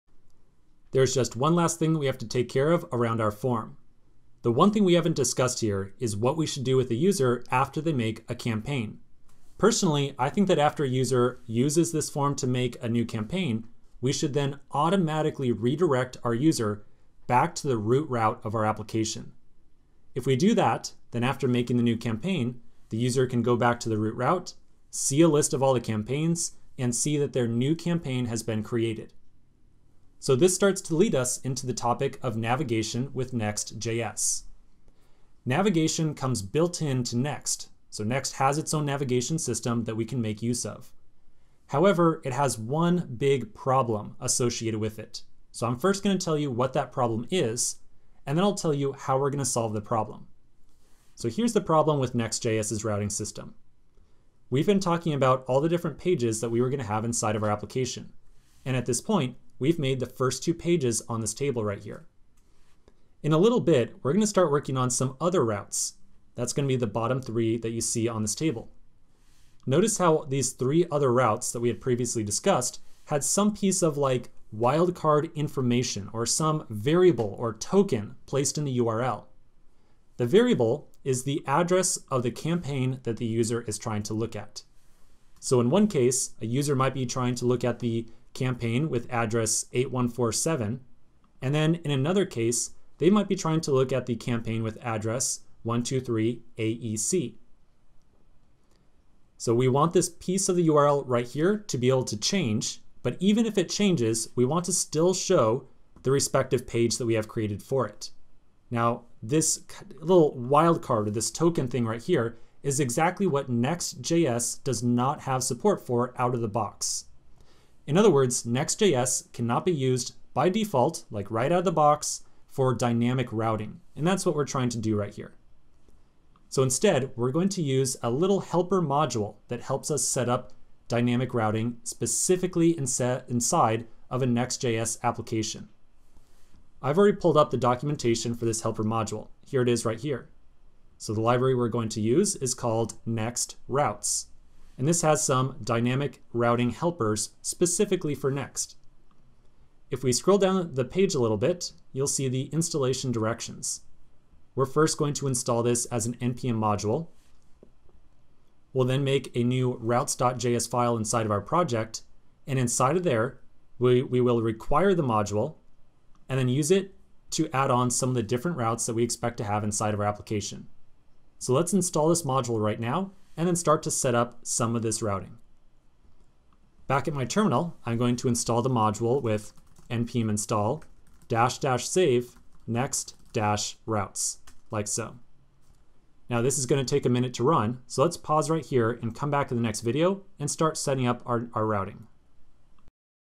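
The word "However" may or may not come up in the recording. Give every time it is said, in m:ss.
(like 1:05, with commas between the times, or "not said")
0:41.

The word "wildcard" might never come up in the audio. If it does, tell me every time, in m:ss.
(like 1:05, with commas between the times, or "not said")
1:14, 1:50.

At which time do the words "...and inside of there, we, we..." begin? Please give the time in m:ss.
2:42.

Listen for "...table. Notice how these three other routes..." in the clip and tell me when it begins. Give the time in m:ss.
1:08.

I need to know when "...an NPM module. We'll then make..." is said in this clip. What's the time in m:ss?
2:36.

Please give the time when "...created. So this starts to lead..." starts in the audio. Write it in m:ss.
0:28.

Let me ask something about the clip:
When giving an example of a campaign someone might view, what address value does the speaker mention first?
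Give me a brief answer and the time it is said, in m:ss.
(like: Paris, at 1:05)
8147, at 1:29.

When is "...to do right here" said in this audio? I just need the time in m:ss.
2:04.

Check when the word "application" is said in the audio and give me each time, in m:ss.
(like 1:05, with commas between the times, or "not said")
0:18, 0:57, 2:15, 2:50.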